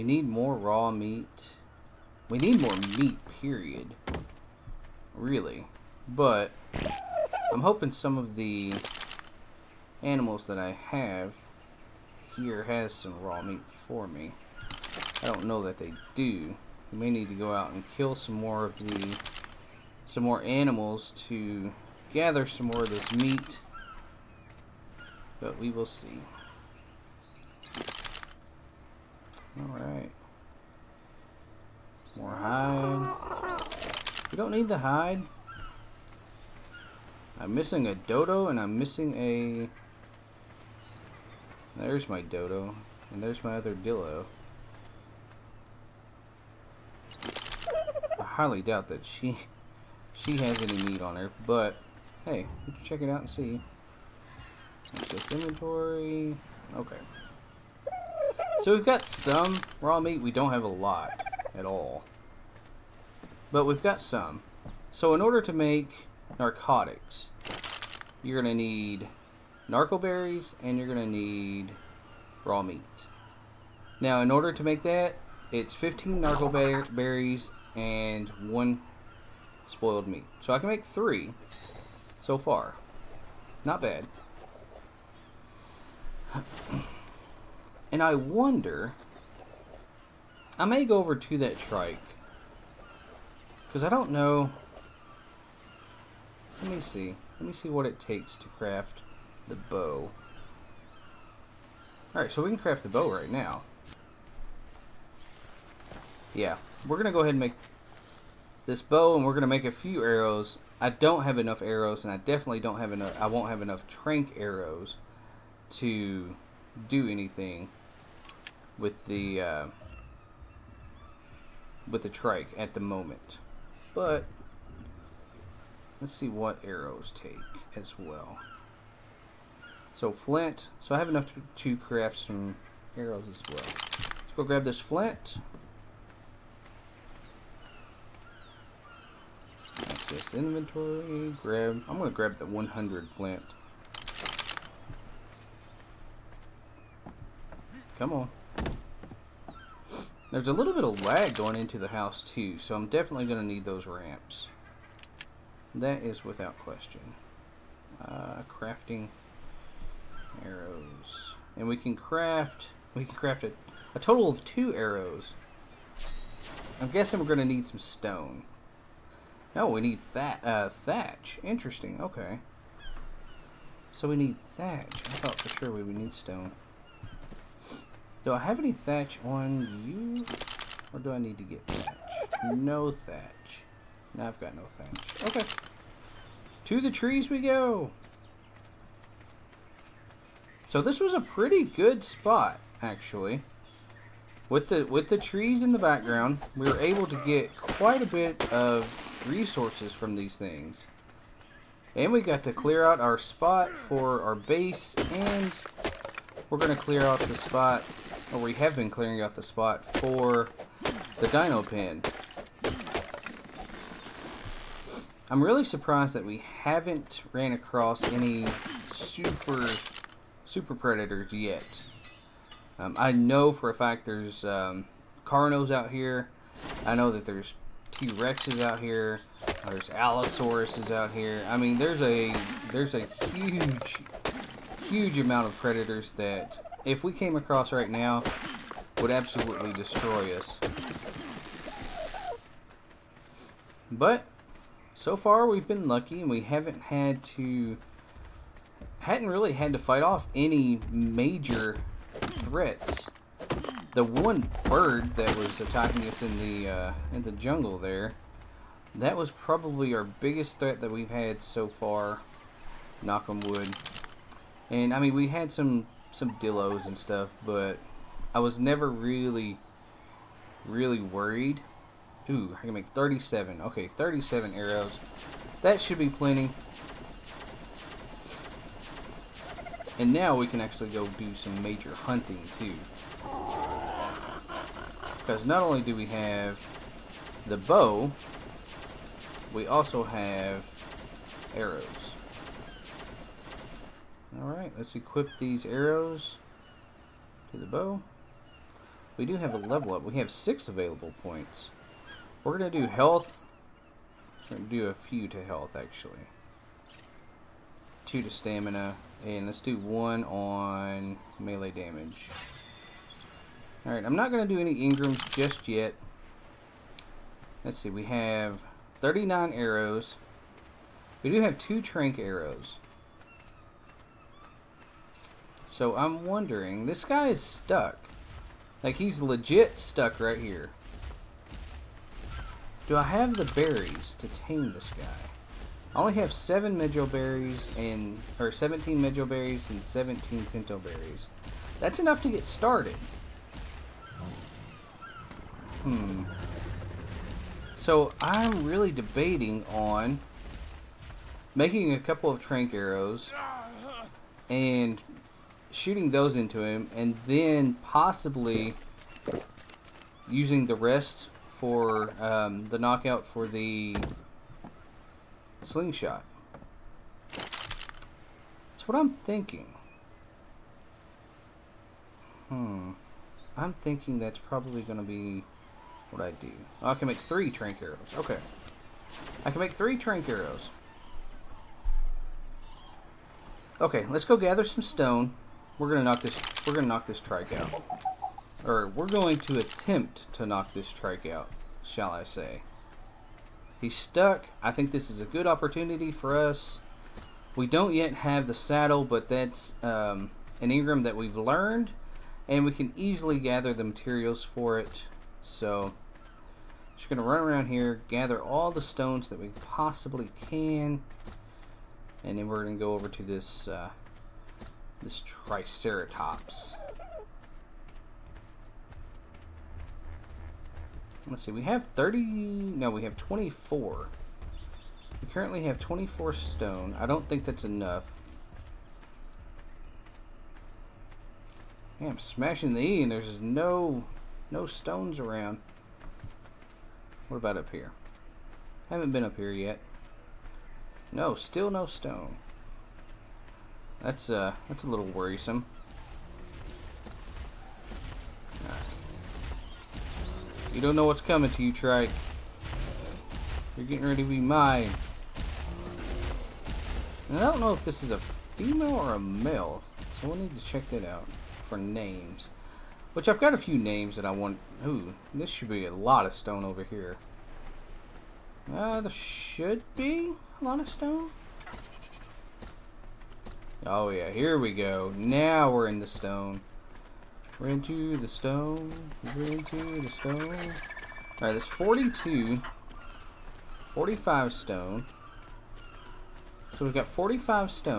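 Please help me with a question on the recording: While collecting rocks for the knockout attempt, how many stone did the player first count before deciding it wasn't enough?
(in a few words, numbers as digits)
24.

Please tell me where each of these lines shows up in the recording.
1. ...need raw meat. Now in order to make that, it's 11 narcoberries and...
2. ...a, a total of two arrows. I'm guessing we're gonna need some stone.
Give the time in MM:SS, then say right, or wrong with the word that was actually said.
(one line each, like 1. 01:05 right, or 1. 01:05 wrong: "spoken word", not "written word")
1. 01:11 wrong: "15", not "11"
2. 02:43 right.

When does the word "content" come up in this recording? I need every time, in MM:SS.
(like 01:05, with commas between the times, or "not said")
not said.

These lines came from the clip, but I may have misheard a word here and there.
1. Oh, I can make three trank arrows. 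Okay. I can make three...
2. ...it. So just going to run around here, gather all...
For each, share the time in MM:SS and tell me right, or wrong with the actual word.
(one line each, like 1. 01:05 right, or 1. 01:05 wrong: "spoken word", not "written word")
1. 06:16 right
2. 06:44 right.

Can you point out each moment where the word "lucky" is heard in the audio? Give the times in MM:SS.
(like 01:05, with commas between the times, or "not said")
04:05.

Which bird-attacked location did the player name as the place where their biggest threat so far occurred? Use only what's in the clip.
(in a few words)
The jungle.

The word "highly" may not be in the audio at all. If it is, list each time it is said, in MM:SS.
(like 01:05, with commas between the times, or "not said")
00:48.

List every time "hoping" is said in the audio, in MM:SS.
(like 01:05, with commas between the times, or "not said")
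00:07.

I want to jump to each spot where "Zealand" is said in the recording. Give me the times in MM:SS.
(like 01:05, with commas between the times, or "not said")
not said.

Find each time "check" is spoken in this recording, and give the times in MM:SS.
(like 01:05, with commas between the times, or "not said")
00:52, 07:40.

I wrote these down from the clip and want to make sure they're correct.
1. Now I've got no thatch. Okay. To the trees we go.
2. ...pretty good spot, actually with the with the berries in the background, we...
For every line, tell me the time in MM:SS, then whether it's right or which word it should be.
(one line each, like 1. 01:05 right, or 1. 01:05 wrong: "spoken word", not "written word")
1. 03:04 right
2. 03:11 wrong: "trees", not "berries".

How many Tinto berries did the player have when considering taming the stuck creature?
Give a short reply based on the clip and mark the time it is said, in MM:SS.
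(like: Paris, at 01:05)
17, at 05:39.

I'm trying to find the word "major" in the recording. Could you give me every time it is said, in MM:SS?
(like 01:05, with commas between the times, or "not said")
04:10, 04:41.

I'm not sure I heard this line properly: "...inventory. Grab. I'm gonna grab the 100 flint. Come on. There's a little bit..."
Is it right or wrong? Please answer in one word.
right.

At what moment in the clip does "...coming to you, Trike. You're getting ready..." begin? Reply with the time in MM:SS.
07:31.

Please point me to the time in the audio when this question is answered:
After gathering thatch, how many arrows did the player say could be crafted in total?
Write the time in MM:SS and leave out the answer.
04:33.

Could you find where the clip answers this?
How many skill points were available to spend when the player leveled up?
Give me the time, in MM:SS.
05:00.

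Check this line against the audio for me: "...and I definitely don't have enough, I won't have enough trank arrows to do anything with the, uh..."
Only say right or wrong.
right.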